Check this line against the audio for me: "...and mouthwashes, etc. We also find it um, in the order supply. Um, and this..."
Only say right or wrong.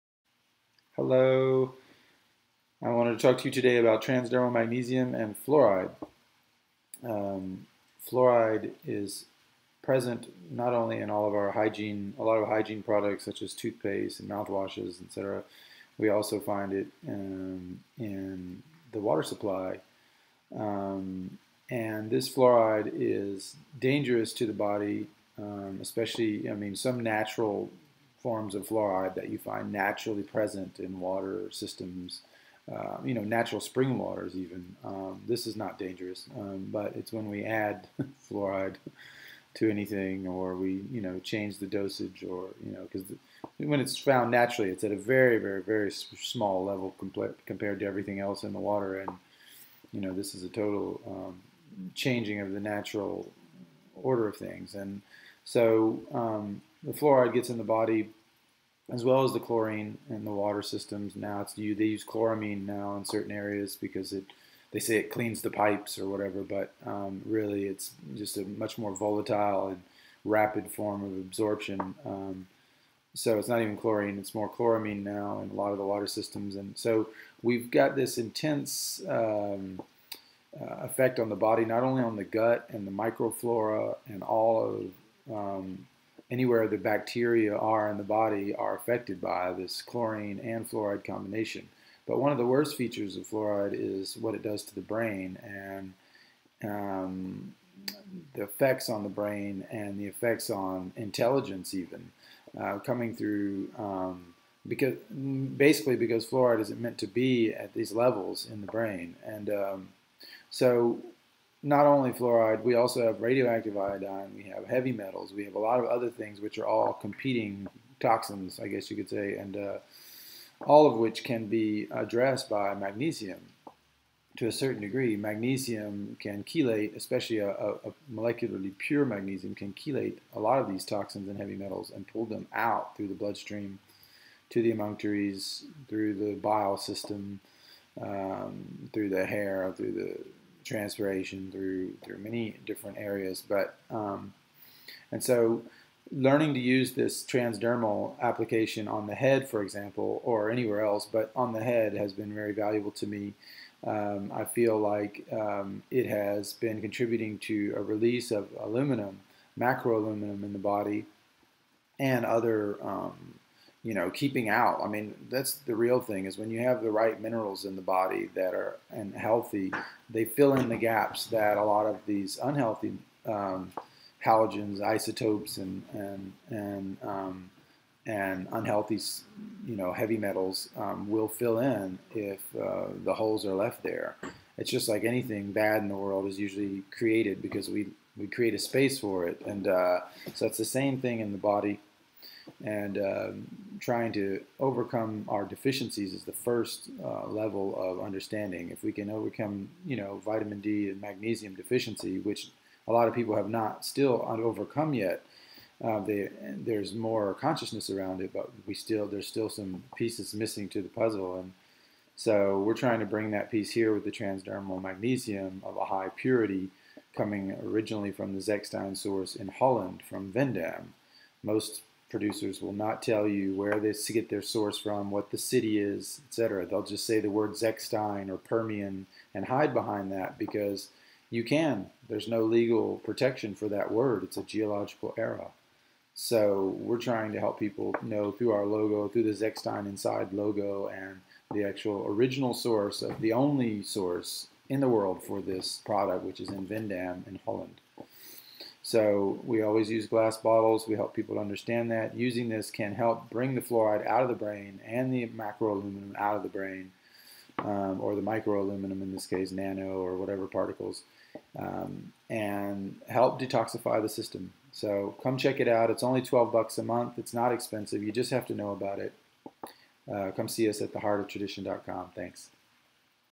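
wrong.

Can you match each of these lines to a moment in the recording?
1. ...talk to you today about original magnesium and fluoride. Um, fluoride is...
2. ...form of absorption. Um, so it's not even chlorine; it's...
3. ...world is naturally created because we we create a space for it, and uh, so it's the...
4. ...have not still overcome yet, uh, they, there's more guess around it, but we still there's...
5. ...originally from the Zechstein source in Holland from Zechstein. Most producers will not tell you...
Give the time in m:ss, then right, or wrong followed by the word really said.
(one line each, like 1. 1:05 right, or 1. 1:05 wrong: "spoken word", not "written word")
1. 0:03 wrong: "transdermal", not "original"
2. 1:10 right
3. 3:05 wrong: "usually", not "naturally"
4. 3:23 wrong: "consciousness", not "guess"
5. 3:37 wrong: "Veendam", not "Zechstein".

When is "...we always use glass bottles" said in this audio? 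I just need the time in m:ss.
4:09.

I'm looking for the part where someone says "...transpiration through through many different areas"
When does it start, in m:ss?
2:20.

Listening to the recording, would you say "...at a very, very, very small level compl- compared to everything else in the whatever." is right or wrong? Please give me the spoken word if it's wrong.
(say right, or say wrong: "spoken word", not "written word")
wrong: "water", not "whatever".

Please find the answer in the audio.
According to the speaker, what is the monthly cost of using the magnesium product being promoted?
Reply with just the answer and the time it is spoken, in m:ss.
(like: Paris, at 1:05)
$12, at 4:26.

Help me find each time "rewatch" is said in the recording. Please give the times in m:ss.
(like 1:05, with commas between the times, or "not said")
not said.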